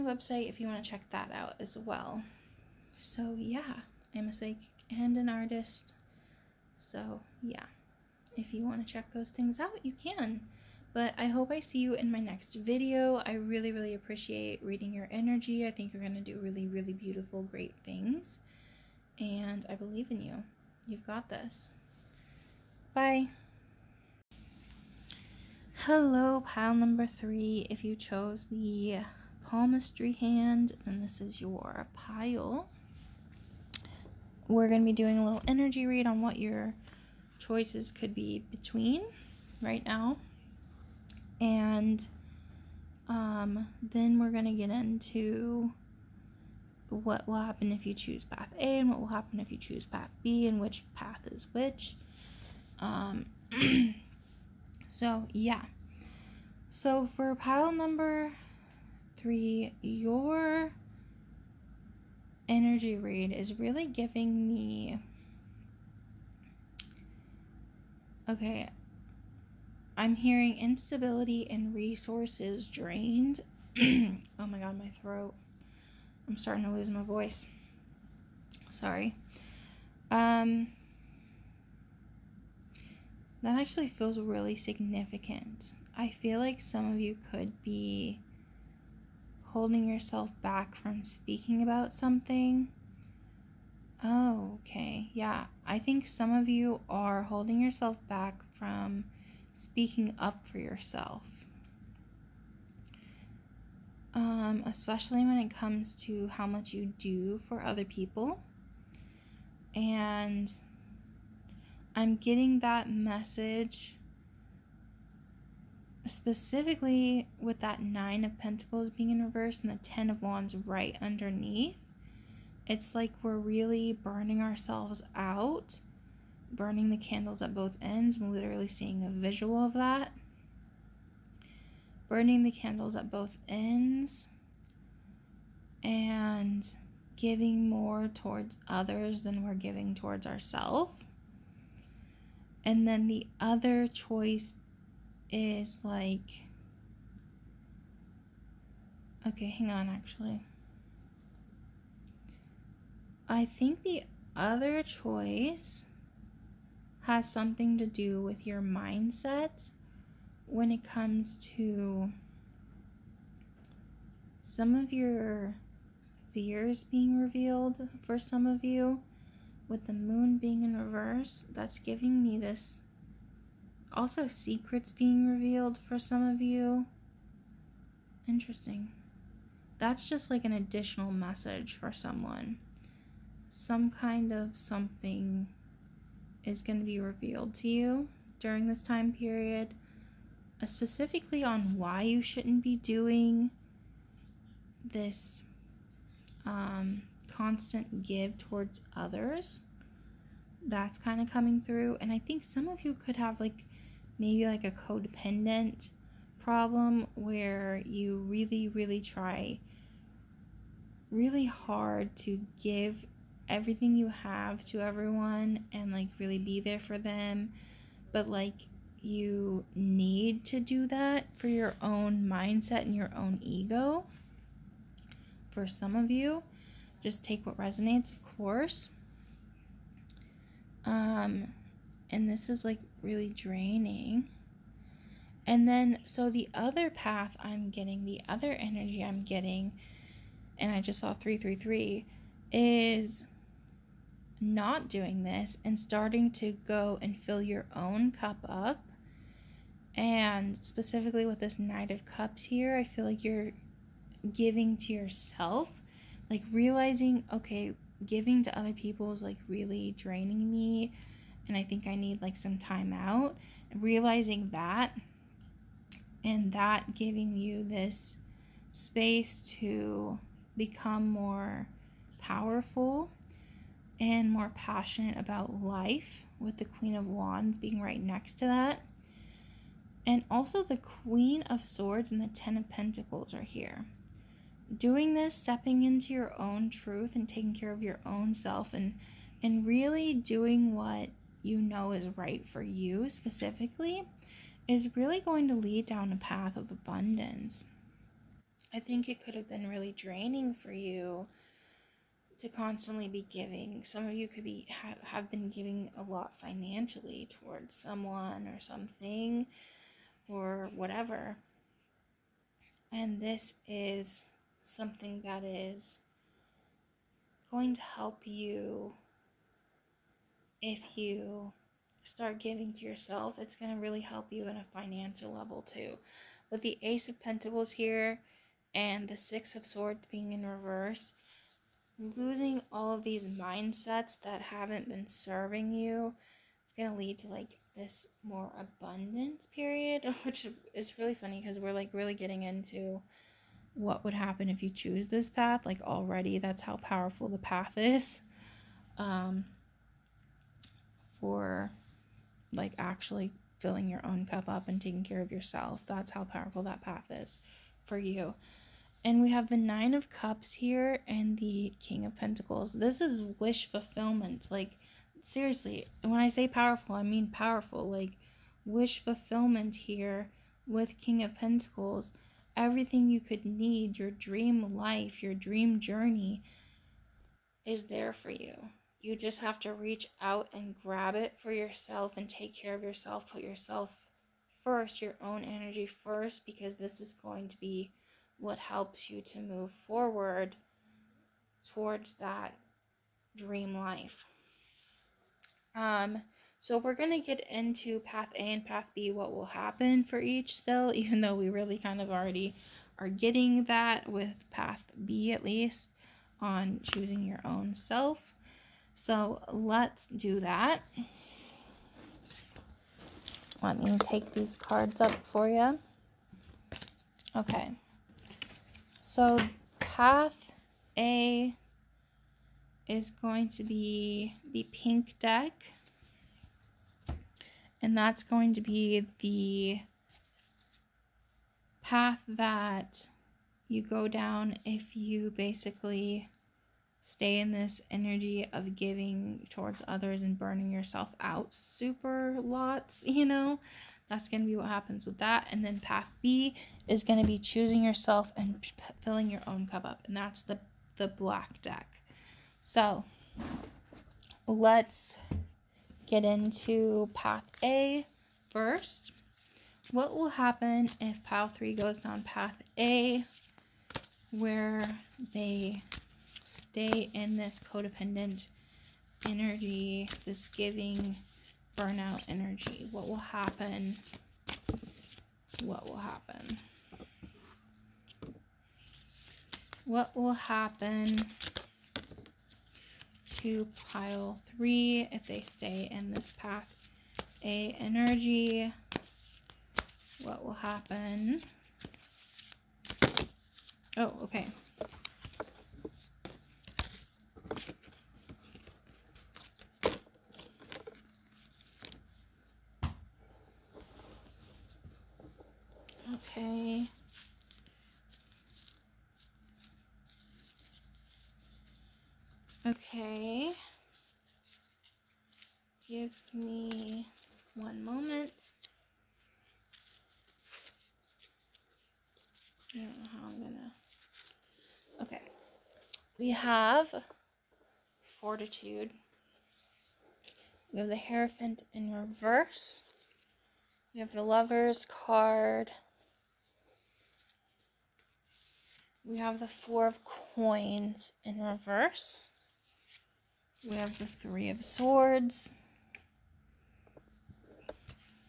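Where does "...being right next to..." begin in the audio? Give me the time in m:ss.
4:37.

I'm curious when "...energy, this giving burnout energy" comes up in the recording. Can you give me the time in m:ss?
7:49.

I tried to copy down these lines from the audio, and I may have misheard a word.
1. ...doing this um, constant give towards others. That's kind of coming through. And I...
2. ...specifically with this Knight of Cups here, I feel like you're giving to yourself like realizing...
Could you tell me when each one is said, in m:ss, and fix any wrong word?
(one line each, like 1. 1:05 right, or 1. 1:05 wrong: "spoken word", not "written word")
1. 3:12 right
2. 4:10 right.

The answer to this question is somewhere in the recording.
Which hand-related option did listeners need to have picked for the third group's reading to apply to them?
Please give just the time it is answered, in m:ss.
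0:29.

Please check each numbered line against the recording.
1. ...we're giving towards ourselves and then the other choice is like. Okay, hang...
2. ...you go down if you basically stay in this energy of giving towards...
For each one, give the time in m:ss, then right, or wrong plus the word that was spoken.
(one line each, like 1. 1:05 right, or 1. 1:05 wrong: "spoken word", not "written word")
1. 2:19 right
2. 7:13 right.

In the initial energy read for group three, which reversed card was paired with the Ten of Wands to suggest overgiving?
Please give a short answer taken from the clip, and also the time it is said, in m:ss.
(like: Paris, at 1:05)
Nine of Pentacles, at 1:57.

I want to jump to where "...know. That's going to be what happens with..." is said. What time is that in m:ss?
7:23.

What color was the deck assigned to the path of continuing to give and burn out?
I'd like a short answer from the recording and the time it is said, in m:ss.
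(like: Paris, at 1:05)
pink, at 7:04.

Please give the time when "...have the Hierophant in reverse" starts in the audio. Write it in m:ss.
8:50.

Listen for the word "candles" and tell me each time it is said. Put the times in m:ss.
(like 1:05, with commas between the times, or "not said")
2:06, 2:12.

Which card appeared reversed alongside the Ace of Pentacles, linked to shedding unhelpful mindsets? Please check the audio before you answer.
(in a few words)
Six of Swords.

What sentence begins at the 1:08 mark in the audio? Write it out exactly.
Okay, I'm hearing instability and resources drained.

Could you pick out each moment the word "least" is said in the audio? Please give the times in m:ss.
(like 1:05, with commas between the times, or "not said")
6:45.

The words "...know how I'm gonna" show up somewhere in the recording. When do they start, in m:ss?
8:43.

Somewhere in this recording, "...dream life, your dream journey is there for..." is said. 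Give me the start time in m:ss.
6:14.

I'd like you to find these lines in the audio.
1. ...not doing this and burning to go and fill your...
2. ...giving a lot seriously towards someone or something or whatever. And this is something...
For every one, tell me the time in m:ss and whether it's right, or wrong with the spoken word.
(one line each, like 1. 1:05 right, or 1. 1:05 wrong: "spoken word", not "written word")
1. 4:04 wrong: "starting", not "burning"
2. 5:05 wrong: "financially", not "seriously".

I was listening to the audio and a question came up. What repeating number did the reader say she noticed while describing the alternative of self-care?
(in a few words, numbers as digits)
333.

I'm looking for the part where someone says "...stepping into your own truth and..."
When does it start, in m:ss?
4:45.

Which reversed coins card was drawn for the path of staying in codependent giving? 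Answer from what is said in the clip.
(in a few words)
Four of Coins.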